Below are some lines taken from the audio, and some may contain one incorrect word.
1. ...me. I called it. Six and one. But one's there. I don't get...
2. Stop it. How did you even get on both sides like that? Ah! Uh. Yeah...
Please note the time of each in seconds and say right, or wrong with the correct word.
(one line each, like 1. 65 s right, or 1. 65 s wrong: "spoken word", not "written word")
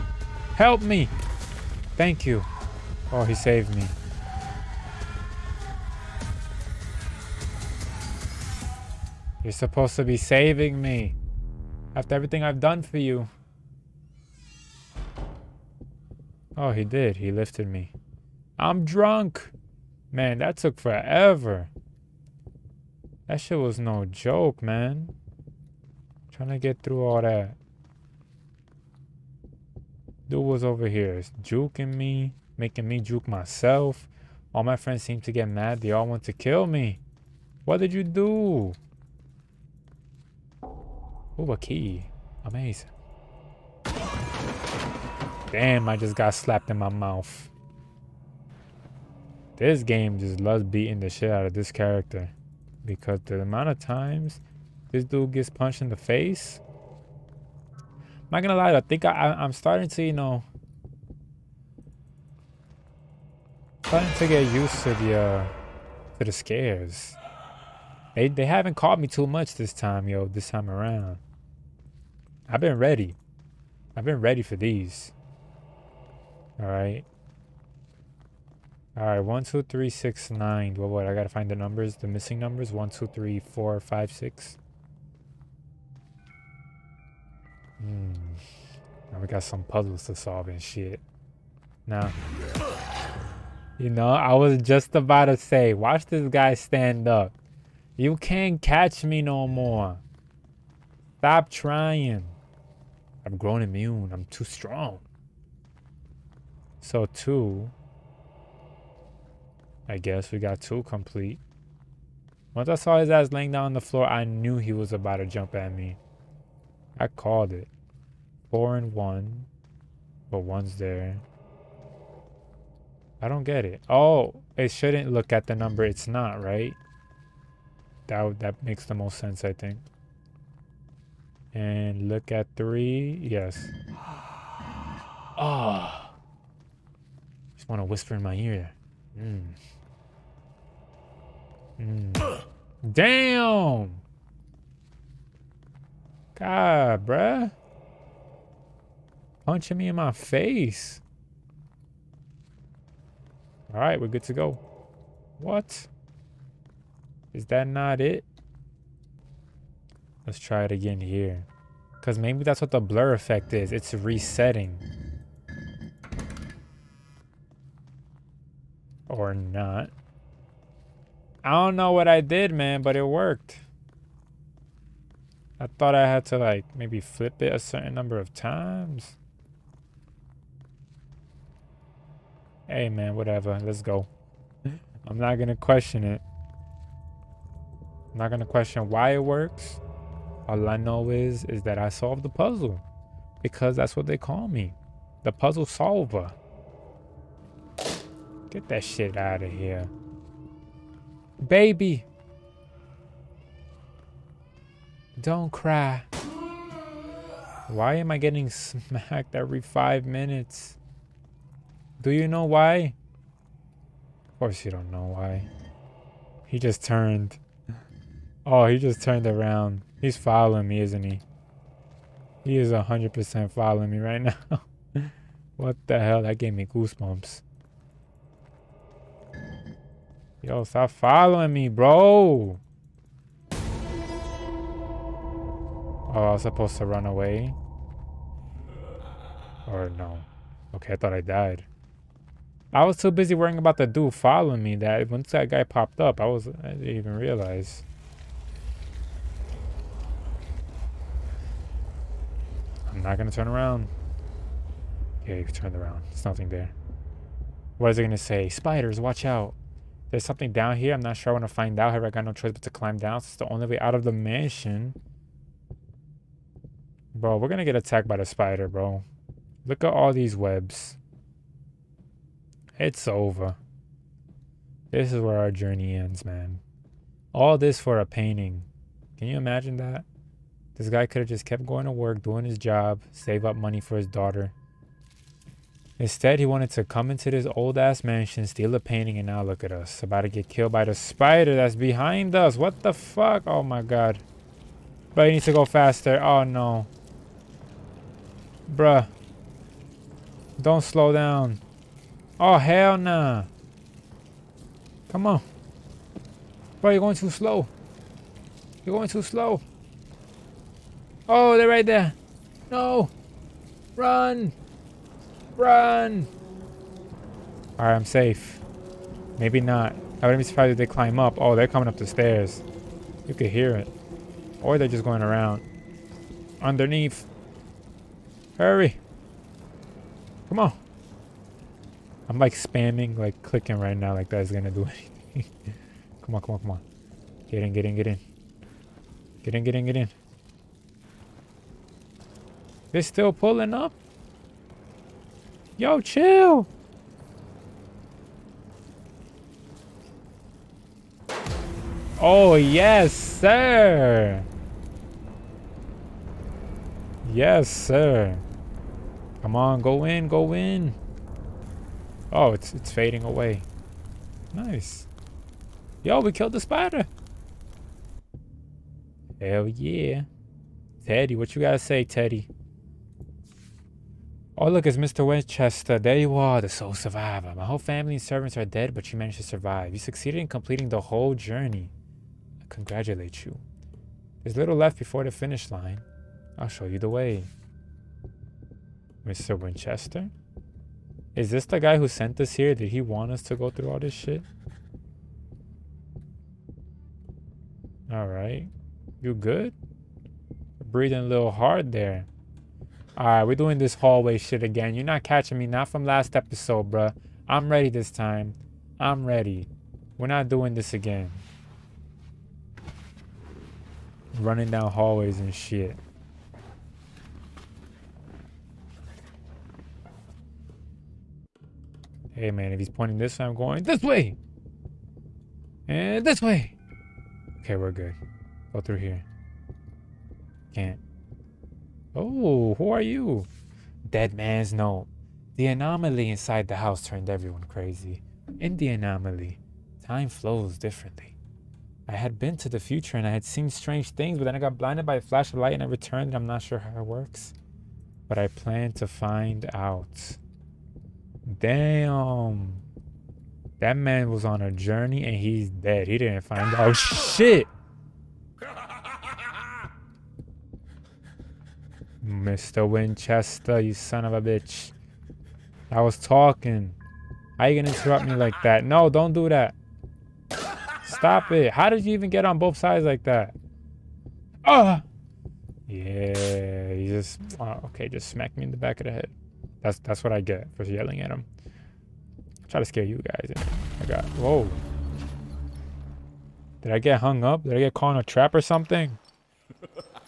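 1. 115 s wrong: "Four", not "Six"
2. 471 s right.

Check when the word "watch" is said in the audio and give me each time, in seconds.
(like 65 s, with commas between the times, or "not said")
95 s, 259 s.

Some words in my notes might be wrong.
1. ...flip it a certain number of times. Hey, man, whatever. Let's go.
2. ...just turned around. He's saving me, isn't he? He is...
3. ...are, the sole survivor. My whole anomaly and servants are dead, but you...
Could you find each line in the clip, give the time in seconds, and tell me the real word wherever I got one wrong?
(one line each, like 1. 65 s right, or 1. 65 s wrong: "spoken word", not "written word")
1. 176 s right
2. 218 s wrong: "following", not "saving"
3. 376 s wrong: "family", not "anomaly".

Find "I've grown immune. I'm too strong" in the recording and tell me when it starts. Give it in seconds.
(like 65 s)
103 s.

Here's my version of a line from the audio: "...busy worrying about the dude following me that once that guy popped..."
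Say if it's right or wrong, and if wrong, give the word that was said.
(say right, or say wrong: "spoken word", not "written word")
right.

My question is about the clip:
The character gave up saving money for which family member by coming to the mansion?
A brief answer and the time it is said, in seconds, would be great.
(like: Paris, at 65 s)
His daughter, at 283 s.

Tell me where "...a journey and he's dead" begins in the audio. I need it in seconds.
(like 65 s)
454 s.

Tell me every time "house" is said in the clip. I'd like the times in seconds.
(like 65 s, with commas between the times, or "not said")
436 s.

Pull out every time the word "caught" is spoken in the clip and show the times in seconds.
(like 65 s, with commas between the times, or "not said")
68 s, 487 s.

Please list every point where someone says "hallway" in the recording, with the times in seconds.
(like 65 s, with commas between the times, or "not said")
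403 s, 414 s.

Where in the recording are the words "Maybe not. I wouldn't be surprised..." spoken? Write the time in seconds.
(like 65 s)
319 s.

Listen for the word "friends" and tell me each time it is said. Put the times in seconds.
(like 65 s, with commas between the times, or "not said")
34 s.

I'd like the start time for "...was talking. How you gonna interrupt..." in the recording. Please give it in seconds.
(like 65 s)
466 s.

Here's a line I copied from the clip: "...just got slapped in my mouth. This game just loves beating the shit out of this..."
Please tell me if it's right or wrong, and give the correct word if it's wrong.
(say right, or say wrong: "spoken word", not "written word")
right.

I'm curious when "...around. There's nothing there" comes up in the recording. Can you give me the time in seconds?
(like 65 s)
255 s.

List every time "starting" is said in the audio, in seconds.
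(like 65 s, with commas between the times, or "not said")
59 s, 63 s.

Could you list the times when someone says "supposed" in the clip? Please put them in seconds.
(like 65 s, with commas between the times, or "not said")
9 s, 236 s.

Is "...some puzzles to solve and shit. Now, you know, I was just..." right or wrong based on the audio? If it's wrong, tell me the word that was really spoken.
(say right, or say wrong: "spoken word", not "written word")
right.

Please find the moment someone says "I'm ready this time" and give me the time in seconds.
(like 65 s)
407 s.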